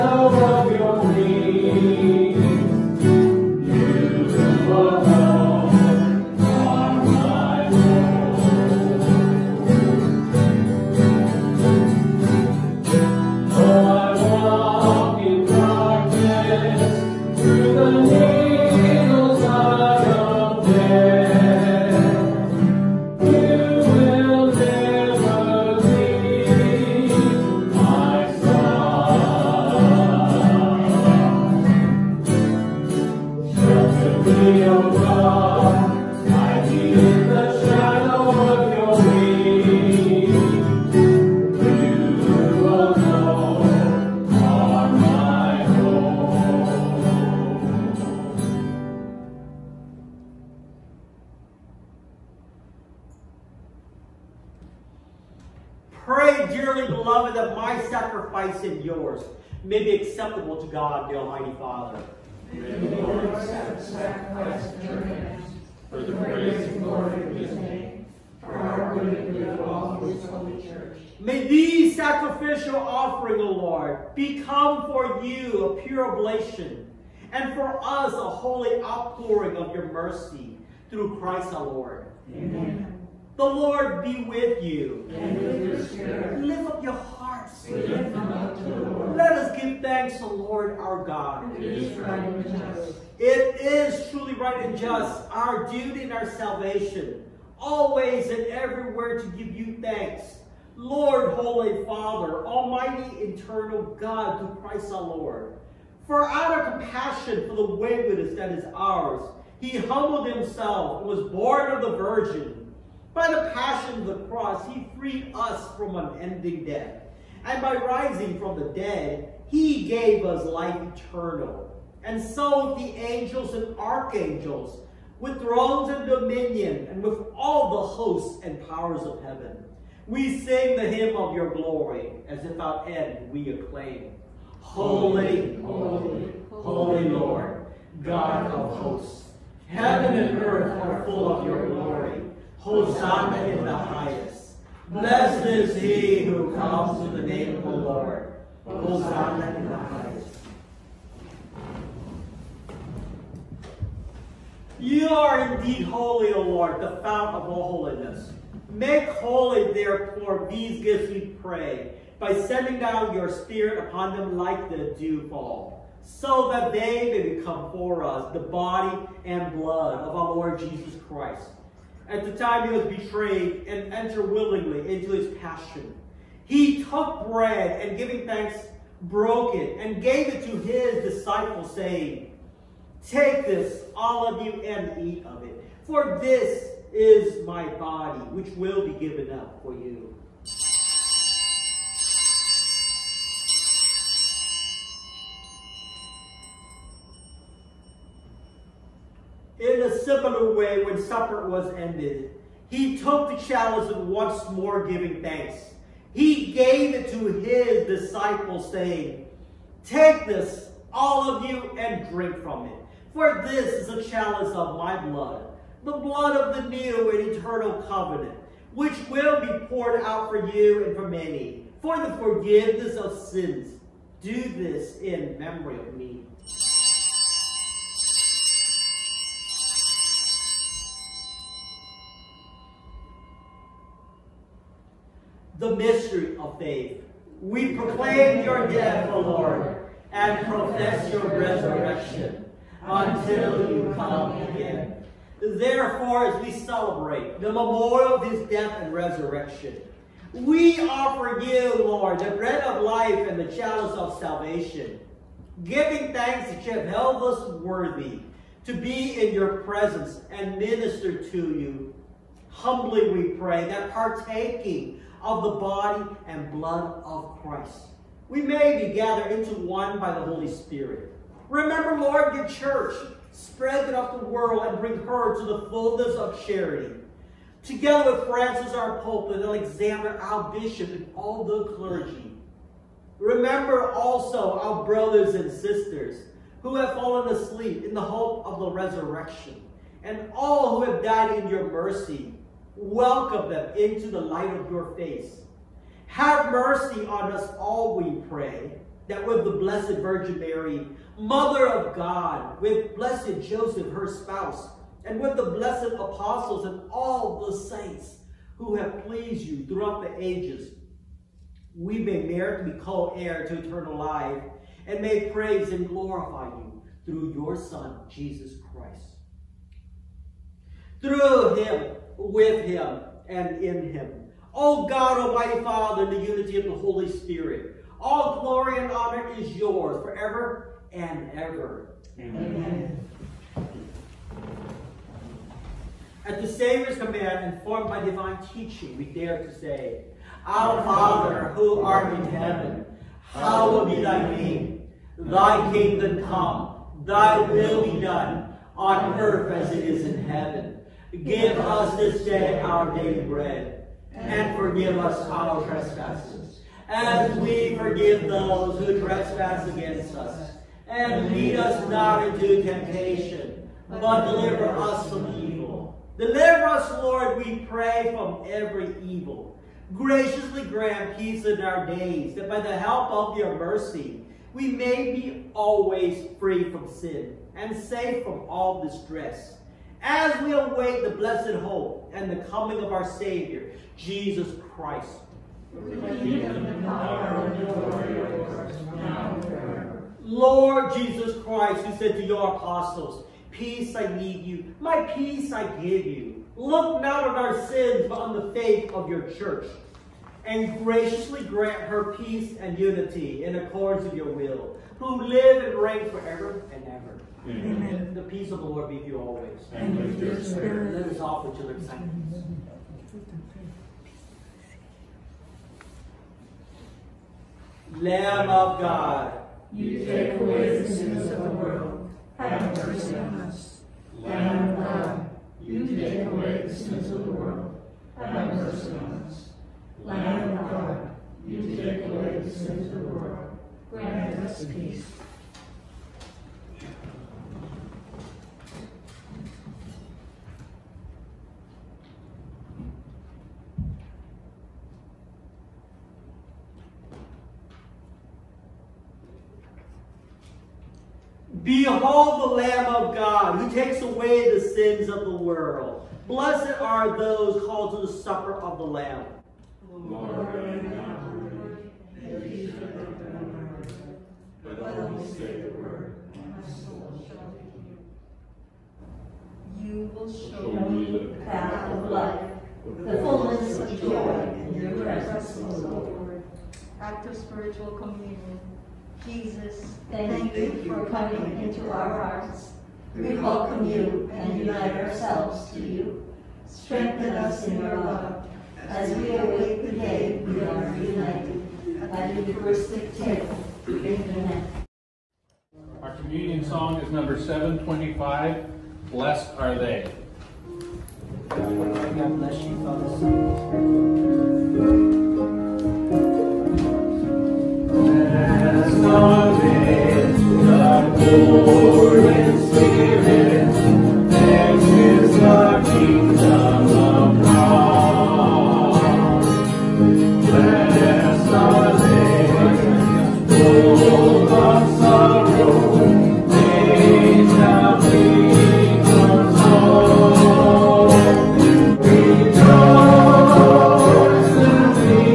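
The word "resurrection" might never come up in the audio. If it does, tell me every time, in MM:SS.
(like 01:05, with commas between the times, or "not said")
04:01, 04:08, 04:48.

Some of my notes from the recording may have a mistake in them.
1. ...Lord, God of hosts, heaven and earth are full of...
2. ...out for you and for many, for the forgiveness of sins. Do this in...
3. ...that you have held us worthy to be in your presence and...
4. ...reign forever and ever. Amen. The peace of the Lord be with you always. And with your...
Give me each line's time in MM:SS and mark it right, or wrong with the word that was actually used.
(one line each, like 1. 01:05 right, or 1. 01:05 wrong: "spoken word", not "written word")
1. 02:17 right
2. 03:40 right
3. 04:16 right
4. 06:45 right.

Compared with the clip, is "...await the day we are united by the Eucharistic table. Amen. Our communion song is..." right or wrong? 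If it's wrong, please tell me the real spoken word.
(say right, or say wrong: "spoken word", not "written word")
right.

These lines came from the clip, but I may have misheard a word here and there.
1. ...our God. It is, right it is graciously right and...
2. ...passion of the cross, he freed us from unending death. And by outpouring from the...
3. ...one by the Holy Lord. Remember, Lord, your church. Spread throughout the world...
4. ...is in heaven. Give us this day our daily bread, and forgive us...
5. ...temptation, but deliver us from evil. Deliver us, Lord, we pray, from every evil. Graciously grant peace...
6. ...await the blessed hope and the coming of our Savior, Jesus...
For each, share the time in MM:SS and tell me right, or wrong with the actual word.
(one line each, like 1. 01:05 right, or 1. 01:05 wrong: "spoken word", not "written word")
1. 01:30 wrong: "truly", not "graciously"
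2. 01:53 wrong: "rising", not "outpouring"
3. 04:29 wrong: "Spirit", not "Lord"
4. 05:49 right
5. 06:02 right
6. 06:20 right.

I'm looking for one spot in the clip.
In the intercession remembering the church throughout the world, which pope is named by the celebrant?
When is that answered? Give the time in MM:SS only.
04:38.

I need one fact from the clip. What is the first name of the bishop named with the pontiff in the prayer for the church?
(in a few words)
Alexander.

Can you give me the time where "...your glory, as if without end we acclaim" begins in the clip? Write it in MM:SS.
02:11.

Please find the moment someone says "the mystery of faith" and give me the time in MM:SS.
03:55.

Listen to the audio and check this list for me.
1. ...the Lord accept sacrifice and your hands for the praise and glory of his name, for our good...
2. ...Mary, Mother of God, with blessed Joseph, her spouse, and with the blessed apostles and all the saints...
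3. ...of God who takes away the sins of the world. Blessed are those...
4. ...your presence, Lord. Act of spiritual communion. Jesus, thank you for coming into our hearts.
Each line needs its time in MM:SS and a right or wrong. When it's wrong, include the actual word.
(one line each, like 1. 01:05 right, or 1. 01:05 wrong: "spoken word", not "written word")
1. 01:02 right
2. 05:00 right
3. 07:32 right
4. 07:54 right.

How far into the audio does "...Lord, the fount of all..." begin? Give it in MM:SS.
02:36.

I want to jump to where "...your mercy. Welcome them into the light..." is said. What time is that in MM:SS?
04:51.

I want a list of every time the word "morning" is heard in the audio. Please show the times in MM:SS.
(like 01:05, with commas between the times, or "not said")
not said.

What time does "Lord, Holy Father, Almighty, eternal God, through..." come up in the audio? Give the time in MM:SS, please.
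01:40.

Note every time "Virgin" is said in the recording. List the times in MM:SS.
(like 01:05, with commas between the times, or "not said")
01:51, 04:59.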